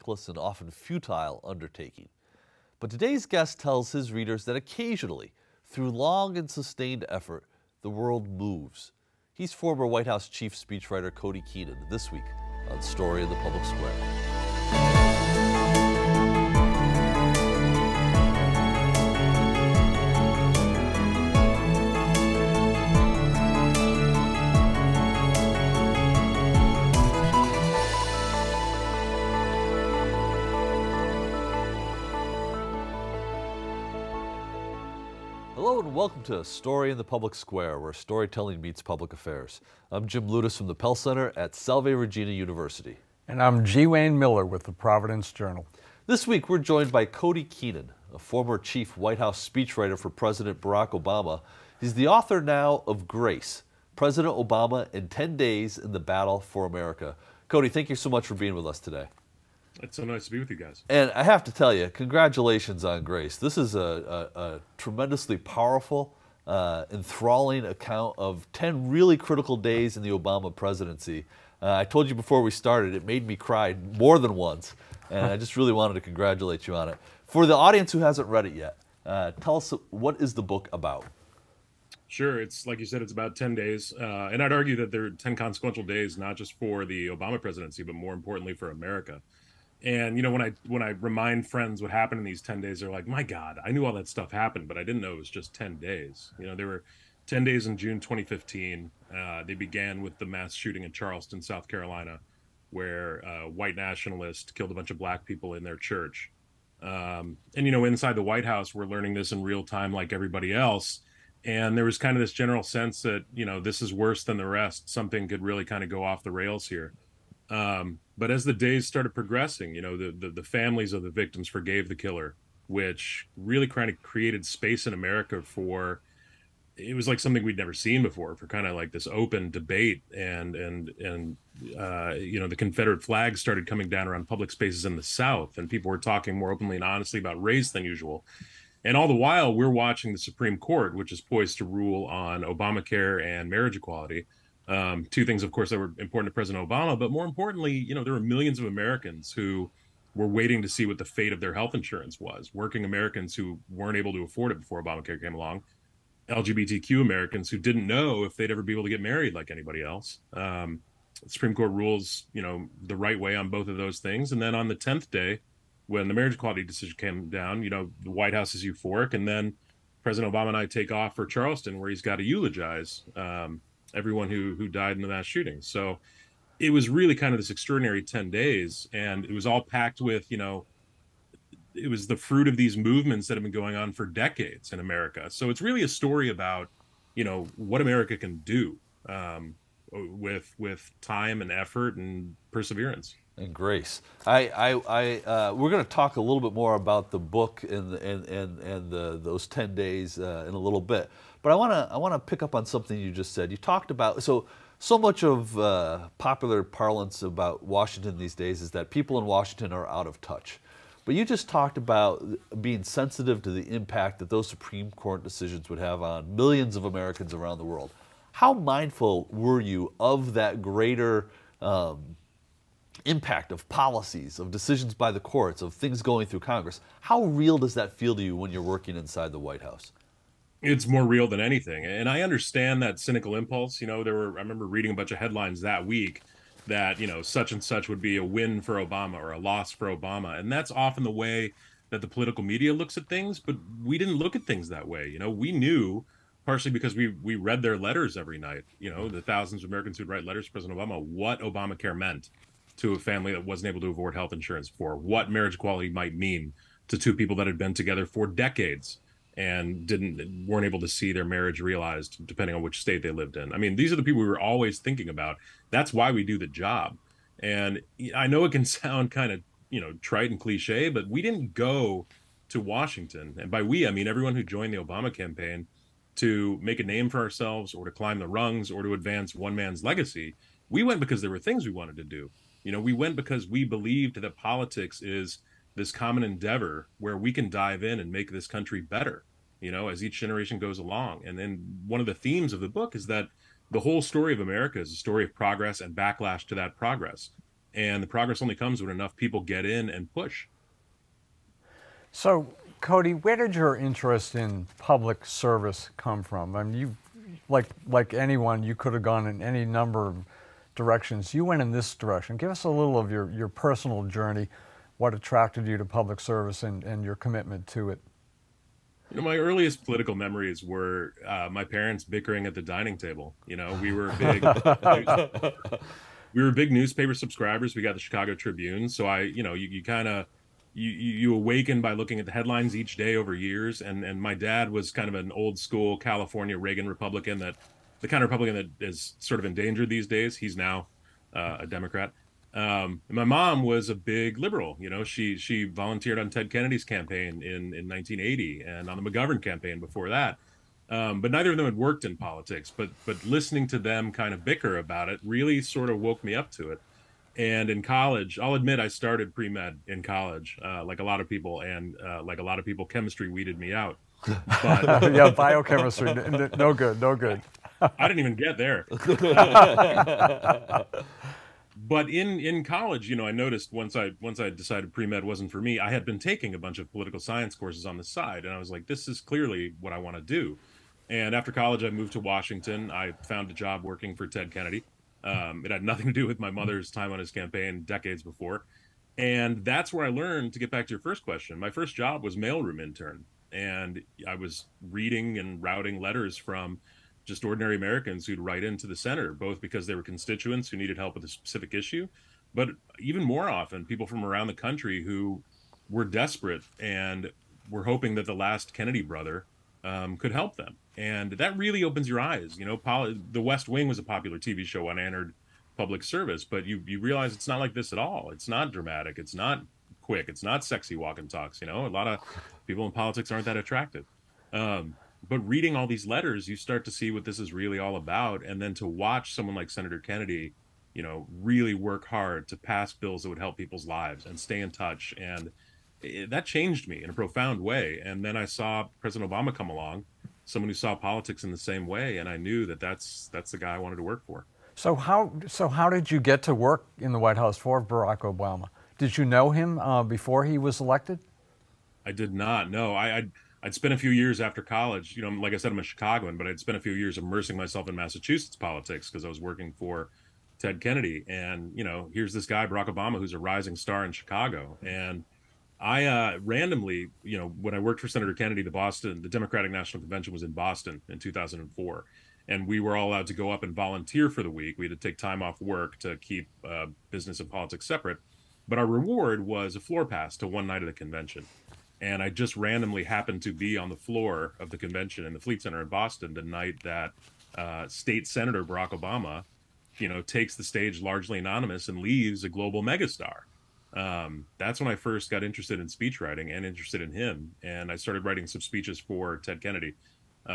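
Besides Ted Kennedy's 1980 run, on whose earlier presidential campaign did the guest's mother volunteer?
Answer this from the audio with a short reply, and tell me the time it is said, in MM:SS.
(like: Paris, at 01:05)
McGovern, at 05:49.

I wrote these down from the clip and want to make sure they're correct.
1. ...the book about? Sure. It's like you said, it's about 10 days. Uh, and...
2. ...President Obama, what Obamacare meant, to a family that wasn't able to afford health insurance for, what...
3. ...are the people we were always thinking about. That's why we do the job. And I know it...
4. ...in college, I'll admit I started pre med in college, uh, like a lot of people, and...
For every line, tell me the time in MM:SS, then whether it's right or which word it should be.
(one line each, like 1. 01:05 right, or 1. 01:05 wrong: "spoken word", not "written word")
1. 01:20 right
2. 04:10 right
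3. 04:23 right
4. 05:57 right.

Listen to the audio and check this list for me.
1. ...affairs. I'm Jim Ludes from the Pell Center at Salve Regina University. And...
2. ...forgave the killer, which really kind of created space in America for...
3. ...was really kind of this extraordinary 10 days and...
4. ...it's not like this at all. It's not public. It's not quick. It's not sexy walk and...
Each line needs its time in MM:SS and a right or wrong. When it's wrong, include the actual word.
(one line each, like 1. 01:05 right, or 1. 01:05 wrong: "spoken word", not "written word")
1. 00:39 right
2. 02:01 right
3. 02:56 right
4. 06:57 wrong: "dramatic", not "public".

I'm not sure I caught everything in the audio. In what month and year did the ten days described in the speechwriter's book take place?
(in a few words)
June 2015.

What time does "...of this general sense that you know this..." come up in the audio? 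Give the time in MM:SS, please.
01:52.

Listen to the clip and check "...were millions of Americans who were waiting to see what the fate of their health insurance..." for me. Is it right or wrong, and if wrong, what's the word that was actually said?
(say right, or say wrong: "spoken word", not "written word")
right.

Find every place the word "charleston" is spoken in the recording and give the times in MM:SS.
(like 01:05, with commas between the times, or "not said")
01:40, 02:51.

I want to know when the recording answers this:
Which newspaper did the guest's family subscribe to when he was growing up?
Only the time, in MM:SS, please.
05:28.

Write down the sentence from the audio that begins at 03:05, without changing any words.
So it's really a story about, you know, what America can do um, with with time and effort and perseverance and grace.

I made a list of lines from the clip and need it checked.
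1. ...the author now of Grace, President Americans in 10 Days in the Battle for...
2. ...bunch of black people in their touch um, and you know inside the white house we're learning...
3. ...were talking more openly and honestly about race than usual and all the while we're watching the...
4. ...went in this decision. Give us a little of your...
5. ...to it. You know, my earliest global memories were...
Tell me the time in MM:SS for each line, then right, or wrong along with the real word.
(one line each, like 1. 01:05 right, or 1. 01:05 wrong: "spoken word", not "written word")
1. 00:51 wrong: "Obama", not "Americans"
2. 01:44 wrong: "church", not "touch"
3. 02:15 right
4. 05:11 wrong: "direction", not "decision"
5. 05:17 wrong: "political", not "global".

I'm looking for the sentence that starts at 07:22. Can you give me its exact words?
And I knew that that's, that's the guy I wanted to work for.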